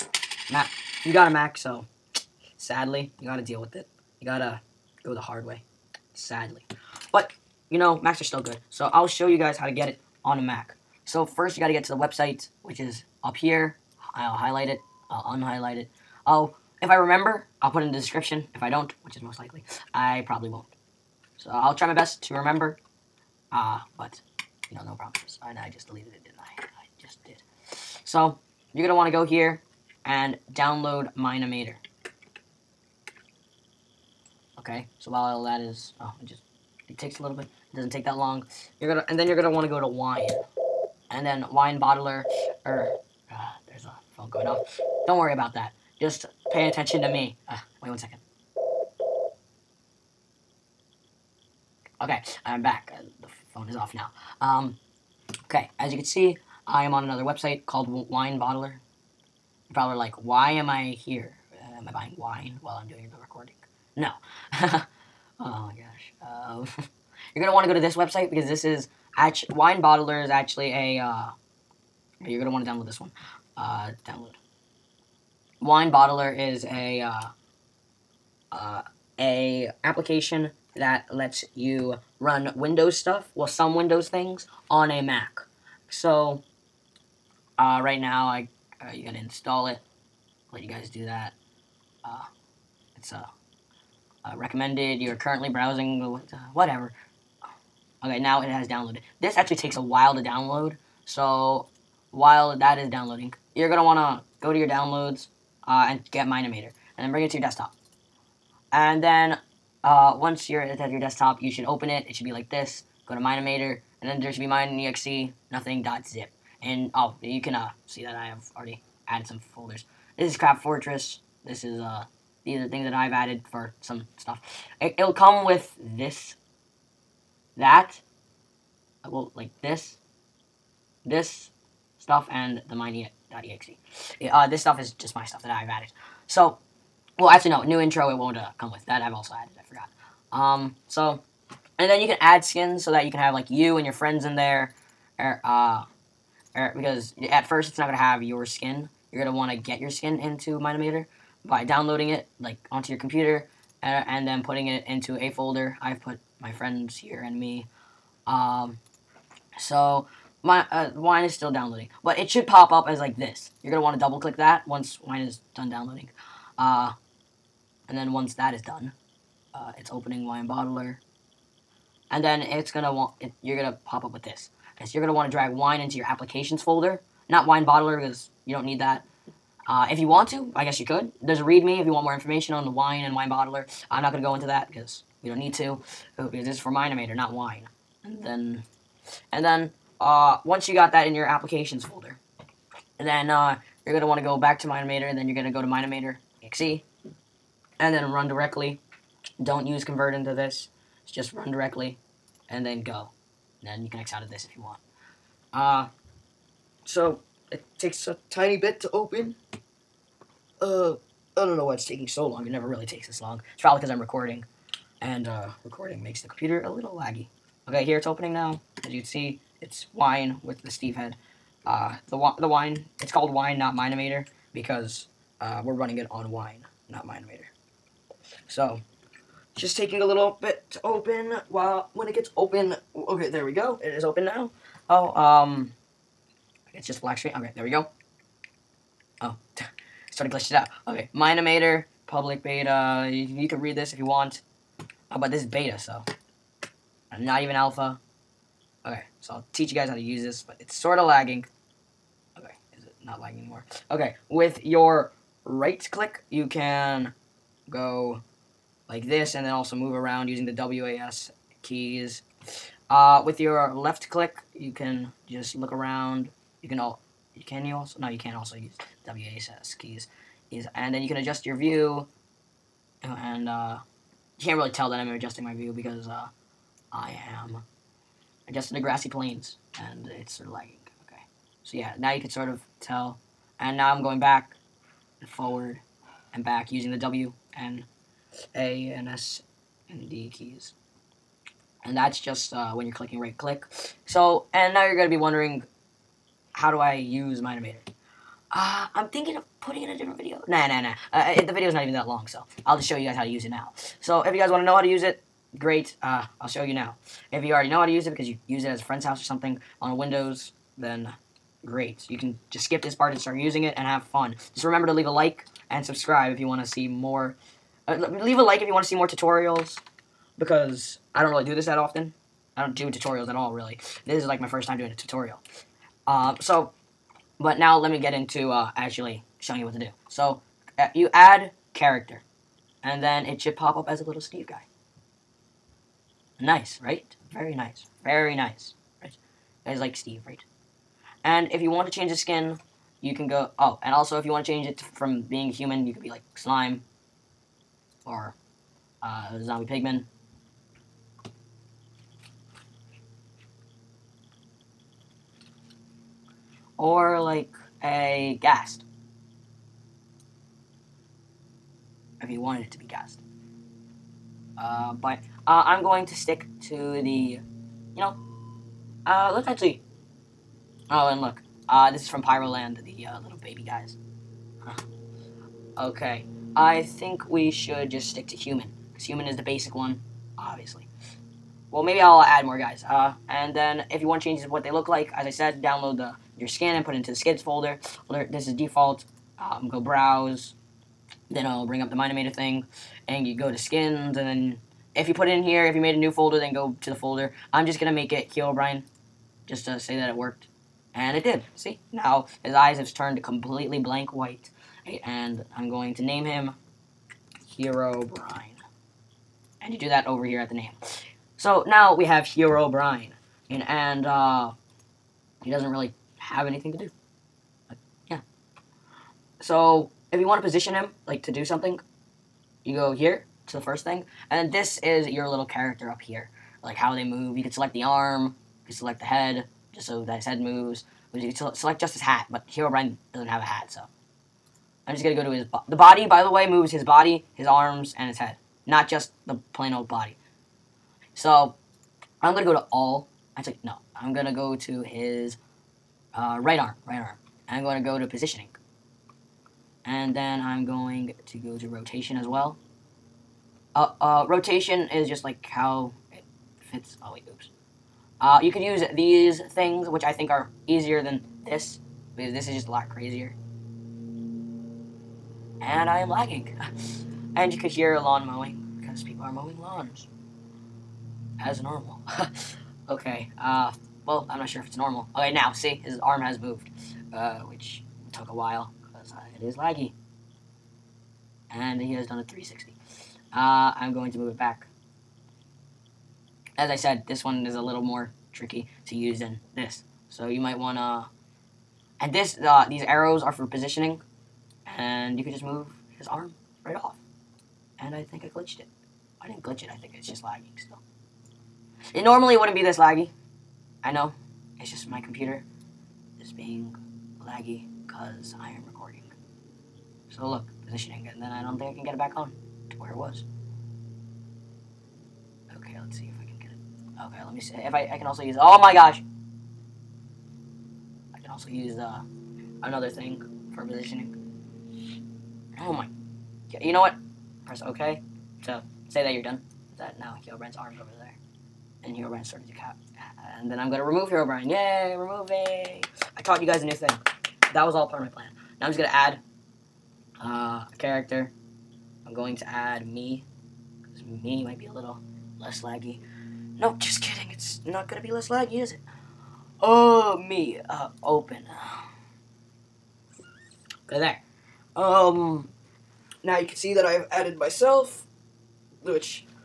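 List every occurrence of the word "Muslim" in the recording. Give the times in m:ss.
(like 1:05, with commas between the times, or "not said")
not said.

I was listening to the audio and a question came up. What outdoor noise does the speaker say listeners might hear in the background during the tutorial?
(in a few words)
lawn mowing.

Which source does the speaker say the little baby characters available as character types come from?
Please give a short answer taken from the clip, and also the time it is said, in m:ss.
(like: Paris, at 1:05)
Pyroland, at 6:11.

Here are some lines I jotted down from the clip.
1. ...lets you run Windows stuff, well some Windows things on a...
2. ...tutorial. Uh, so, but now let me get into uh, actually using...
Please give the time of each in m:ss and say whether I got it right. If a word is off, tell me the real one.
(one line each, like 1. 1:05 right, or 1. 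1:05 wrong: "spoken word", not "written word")
1. 1:21 right
2. 5:24 wrong: "showing", not "using".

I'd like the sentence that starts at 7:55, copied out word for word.
Okay, now, see, his arm has moved, uh, which took a while because it is laggy.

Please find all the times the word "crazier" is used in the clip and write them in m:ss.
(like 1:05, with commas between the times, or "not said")
7:42.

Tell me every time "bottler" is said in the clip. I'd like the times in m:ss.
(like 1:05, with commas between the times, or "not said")
0:41, 0:58, 1:09, 1:15, 2:50, 2:57, 3:03.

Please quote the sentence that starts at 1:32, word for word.
Uh, it's a uh, uh, recommended, you're currently browsing, uh, uh, whatever.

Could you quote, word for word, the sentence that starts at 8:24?
It's just my computer is being laggy because I am recording.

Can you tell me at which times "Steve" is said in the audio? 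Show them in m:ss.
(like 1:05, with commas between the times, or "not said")
3:40, 5:34, 5:39.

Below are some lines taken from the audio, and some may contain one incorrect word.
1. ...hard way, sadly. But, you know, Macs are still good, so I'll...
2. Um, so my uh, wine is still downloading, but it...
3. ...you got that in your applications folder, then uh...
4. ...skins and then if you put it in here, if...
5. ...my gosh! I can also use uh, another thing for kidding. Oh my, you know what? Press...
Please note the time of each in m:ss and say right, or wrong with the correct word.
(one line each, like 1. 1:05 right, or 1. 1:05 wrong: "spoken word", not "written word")
1. 0:05 right
2. 2:38 right
3. 3:10 right
4. 6:33 right
5. 8:38 wrong: "positioning", not "kidding".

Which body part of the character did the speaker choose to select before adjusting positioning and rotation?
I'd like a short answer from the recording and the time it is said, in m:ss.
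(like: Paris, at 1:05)
right arm, at 7:24.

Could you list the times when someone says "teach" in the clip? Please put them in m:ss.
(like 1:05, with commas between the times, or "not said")
4:09.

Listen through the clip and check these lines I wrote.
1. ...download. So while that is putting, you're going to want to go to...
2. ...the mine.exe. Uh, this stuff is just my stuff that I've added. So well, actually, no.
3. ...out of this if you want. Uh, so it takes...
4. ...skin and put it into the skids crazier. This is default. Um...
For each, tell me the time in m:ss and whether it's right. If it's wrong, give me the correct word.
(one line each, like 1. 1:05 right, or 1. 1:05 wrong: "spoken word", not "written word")
1. 1:40 wrong: "downloading", not "putting"
2. 2:12 right
3. 3:24 right
4. 6:26 wrong: "folder", not "crazier".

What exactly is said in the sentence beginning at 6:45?
And I'm going to name him Herobrine.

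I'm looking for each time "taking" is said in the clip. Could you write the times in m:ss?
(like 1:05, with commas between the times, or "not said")
3:31, 3:49.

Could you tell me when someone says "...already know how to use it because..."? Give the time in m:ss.
5:07.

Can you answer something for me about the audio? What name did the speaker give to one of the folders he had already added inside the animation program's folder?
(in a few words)
Crab Fortress.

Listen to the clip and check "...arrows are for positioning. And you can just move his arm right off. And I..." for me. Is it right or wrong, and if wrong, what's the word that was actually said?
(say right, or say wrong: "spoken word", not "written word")
right.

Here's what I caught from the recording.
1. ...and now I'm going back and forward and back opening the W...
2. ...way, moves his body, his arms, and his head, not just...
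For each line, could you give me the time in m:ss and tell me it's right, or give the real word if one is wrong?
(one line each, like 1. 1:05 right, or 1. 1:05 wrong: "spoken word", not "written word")
1. 4:43 wrong: "using", not "opening"
2. 7:16 right.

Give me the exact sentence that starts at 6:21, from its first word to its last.
Well, maybe I'll add more guys.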